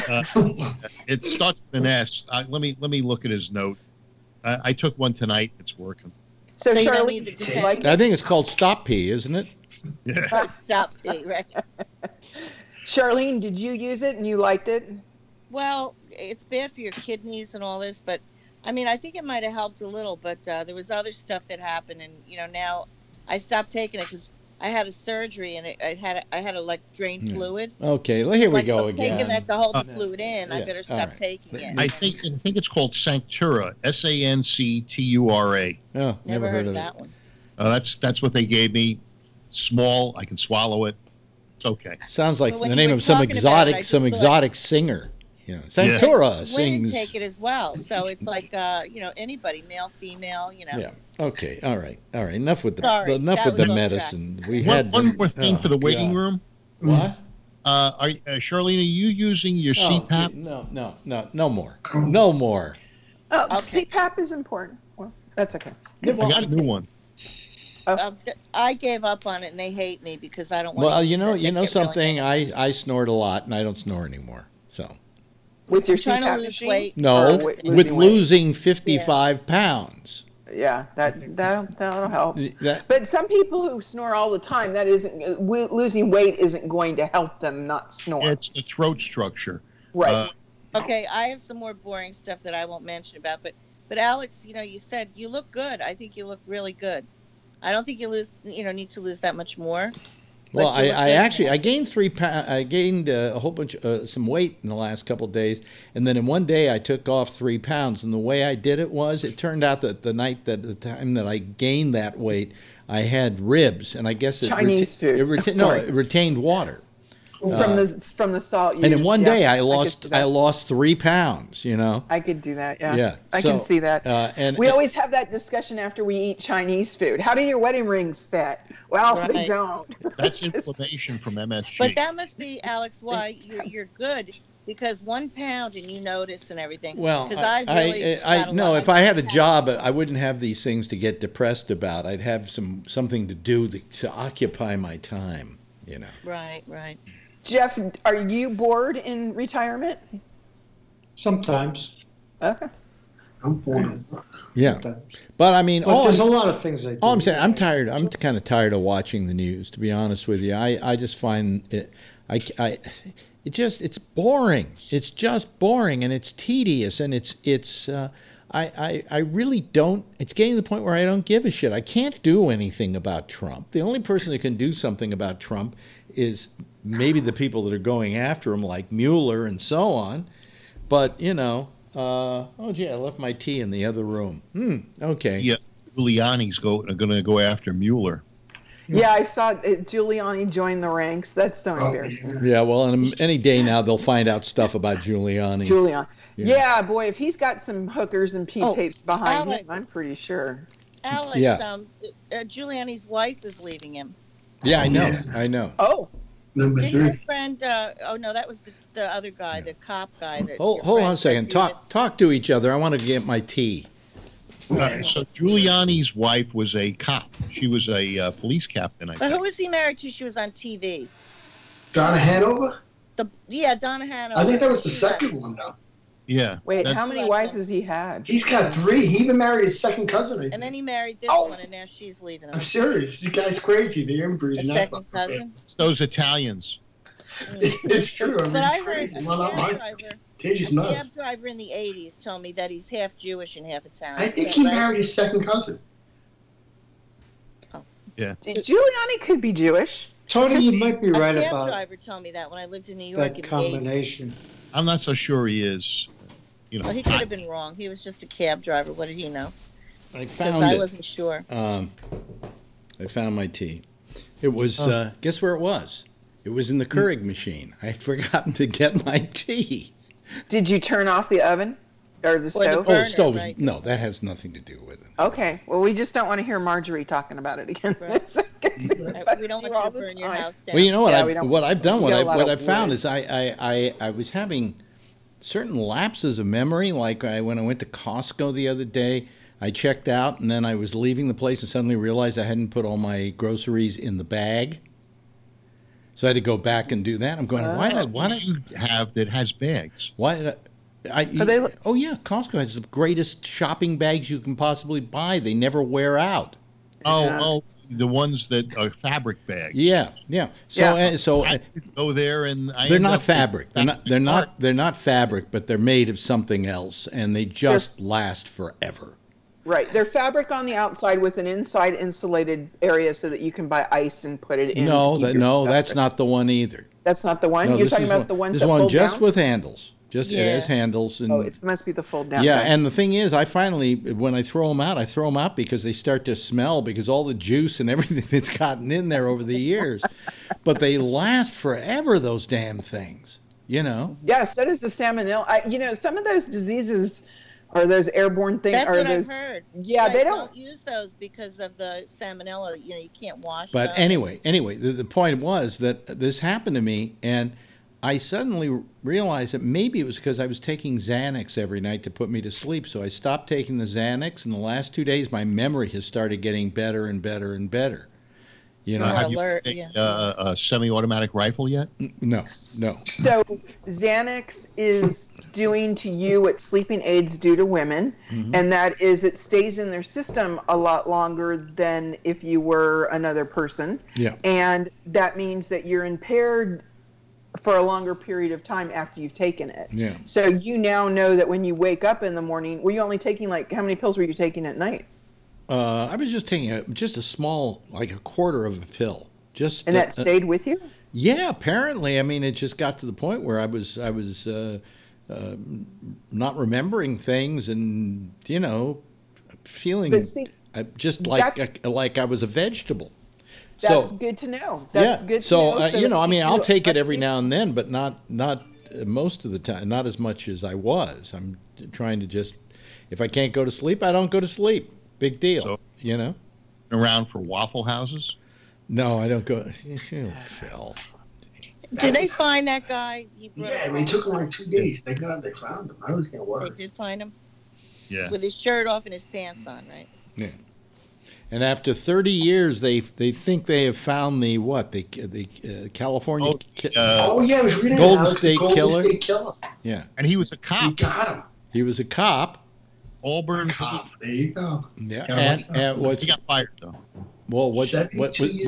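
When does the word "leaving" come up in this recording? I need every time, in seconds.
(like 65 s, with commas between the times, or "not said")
203 s, 232 s, 290 s.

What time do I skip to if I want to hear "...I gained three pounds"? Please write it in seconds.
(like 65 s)
101 s.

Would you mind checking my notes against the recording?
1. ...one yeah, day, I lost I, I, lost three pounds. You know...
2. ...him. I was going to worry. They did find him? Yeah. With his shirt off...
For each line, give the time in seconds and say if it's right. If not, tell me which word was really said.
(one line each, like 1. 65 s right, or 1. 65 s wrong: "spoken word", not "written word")
1. 119 s right
2. 435 s right.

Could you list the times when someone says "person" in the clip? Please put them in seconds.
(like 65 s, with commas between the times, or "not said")
174 s, 383 s.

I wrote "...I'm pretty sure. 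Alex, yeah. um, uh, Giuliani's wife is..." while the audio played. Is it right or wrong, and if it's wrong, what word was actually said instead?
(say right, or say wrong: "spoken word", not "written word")
right.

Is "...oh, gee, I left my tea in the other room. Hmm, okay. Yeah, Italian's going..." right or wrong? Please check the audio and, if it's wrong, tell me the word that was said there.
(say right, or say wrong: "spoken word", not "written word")
wrong: "Giuliani", not "Italian".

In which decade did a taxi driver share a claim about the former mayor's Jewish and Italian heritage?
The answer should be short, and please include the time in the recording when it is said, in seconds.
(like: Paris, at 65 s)
1980s, at 241 s.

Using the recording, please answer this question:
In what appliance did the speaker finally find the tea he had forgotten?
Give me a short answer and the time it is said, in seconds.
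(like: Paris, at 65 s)
Keurig machine, at 266 s.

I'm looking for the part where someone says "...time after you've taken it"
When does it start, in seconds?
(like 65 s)
388 s.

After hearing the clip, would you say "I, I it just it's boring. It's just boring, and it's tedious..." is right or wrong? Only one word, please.
right.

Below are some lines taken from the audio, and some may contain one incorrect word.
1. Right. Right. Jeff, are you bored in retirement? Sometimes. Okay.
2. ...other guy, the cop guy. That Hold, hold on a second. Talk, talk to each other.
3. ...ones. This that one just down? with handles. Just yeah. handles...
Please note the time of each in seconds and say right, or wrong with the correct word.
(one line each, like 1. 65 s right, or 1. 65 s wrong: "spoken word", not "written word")
1. 146 s right
2. 209 s right
3. 328 s right.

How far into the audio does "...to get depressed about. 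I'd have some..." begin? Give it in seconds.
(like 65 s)
140 s.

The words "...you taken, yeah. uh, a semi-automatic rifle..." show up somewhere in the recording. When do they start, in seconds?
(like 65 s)
369 s.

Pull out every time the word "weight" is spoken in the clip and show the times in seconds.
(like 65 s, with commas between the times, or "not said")
76 s, 86 s, 104 s, 112 s.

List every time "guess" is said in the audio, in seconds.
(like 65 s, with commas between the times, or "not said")
114 s, 265 s.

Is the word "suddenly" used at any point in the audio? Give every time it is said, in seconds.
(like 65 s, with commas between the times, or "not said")
291 s, 358 s.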